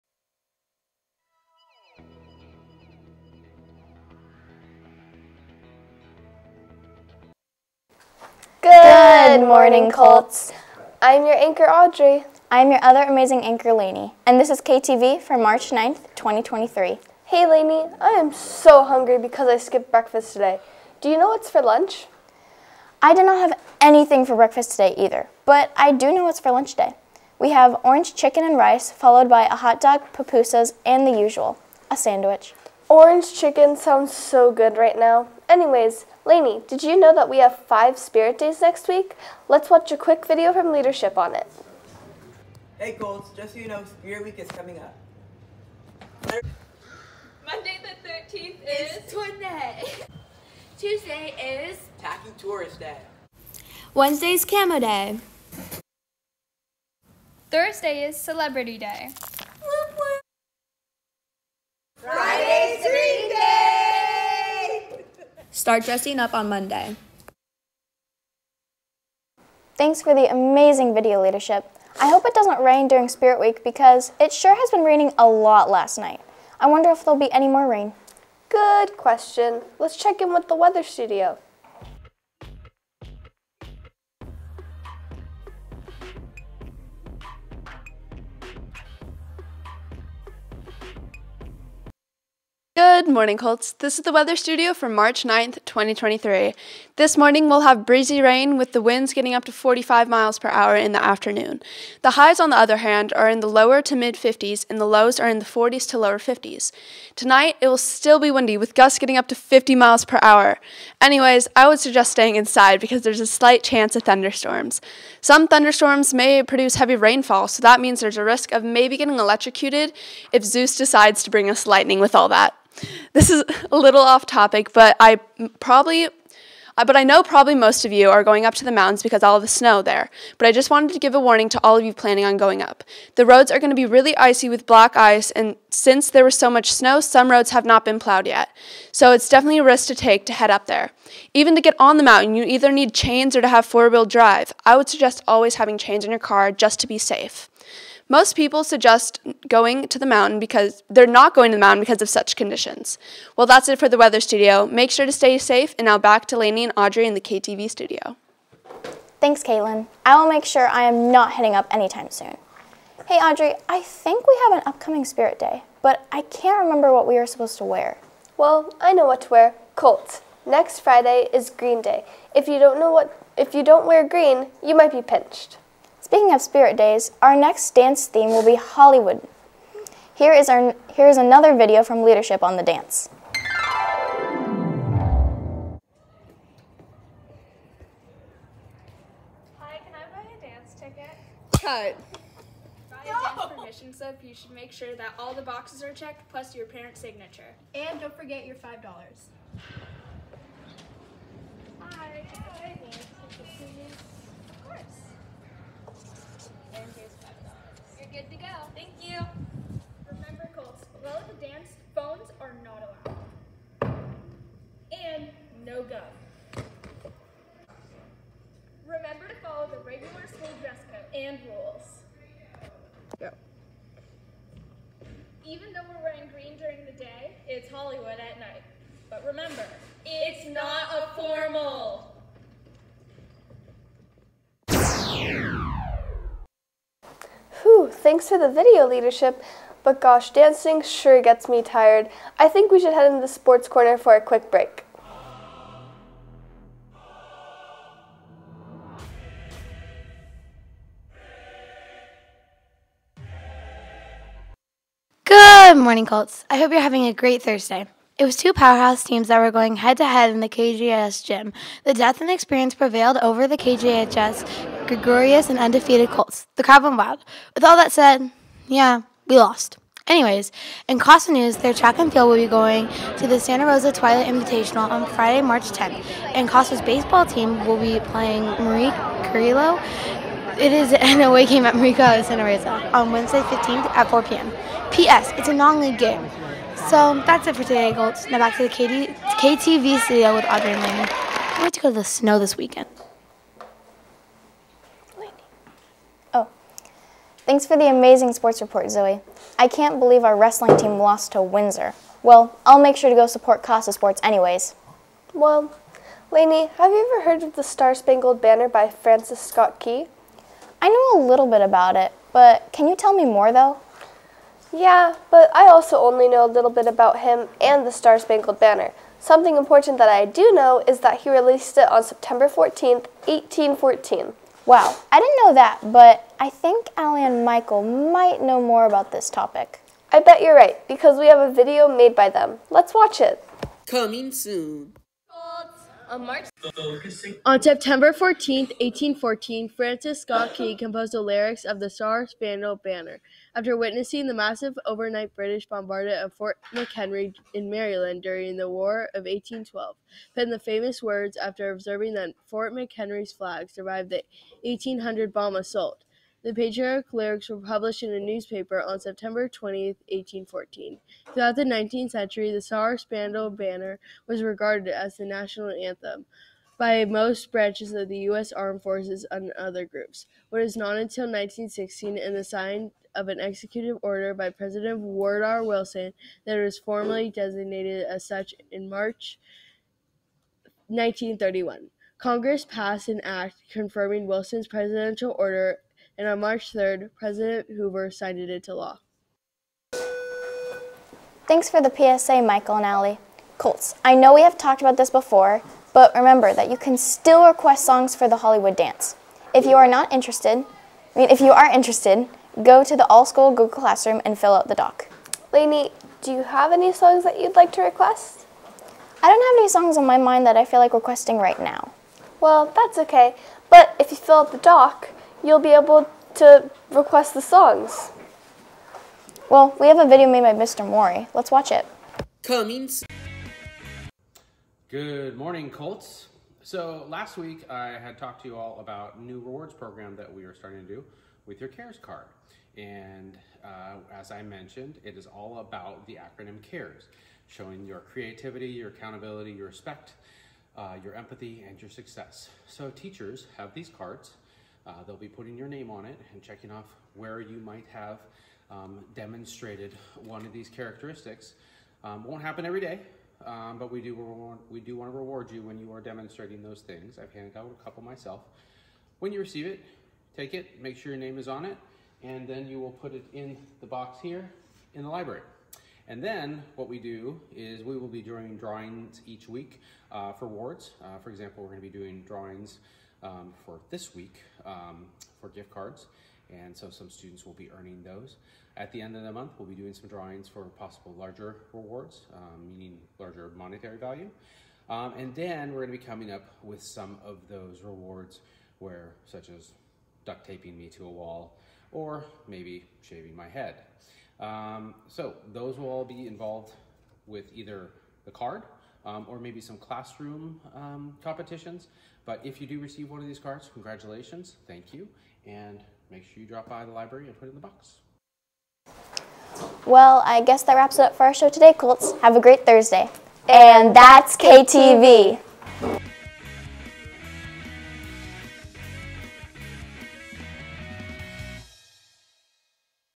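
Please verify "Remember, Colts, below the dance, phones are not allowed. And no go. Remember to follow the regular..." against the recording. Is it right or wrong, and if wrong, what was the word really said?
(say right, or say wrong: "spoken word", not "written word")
right.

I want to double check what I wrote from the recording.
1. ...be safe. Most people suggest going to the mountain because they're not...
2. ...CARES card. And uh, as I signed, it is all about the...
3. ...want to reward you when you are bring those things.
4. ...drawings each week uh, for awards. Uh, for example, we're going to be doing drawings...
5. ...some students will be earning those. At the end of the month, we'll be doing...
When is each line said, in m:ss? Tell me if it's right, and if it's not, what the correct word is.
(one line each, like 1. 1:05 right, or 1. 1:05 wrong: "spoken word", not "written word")
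1. 2:26 right
2. 7:11 wrong: "mentioned", not "signed"
3. 7:34 wrong: "demonstrating", not "bring"
4. 7:48 right
5. 7:56 right.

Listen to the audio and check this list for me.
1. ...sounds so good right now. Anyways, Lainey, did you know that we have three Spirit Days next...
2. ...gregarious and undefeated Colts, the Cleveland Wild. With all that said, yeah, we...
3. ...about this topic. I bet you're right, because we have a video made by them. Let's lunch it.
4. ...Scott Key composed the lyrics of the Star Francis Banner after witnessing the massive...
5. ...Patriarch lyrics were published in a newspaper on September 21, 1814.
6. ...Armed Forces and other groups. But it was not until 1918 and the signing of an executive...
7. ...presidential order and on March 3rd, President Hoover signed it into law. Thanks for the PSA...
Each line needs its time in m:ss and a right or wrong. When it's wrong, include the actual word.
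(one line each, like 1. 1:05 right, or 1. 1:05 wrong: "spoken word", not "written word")
1. 0:33 wrong: "five", not "three"
2. 4:24 right
3. 5:28 wrong: "watch", not "lunch"
4. 5:40 wrong: "Spangled", not "Francis"
5. 5:56 wrong: "20", not "21"
6. 6:08 wrong: "1916", not "1918"
7. 6:24 right.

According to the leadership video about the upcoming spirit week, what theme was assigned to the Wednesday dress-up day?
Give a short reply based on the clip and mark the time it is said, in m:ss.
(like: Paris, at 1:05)
Camo Day, at 0:54.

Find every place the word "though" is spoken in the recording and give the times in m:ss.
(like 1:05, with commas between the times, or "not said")
3:45, 5:13.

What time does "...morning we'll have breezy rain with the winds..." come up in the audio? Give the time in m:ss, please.
1:37.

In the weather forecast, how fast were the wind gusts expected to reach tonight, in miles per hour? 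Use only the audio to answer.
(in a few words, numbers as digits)
50.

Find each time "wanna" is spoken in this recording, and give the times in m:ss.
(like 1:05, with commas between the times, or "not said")
not said.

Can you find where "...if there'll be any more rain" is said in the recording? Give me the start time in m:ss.
1:16.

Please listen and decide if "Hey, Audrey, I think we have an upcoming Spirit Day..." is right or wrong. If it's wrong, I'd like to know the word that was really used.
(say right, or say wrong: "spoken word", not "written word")
right.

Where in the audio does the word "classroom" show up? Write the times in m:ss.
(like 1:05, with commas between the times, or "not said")
6:43, 8:19.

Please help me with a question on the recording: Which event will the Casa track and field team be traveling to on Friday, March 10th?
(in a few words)
Santa Rosa Twilight Invitational.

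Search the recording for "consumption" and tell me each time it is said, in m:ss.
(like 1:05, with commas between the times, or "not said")
not said.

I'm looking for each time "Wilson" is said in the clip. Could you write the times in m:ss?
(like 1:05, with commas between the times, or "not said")
6:15, 6:24.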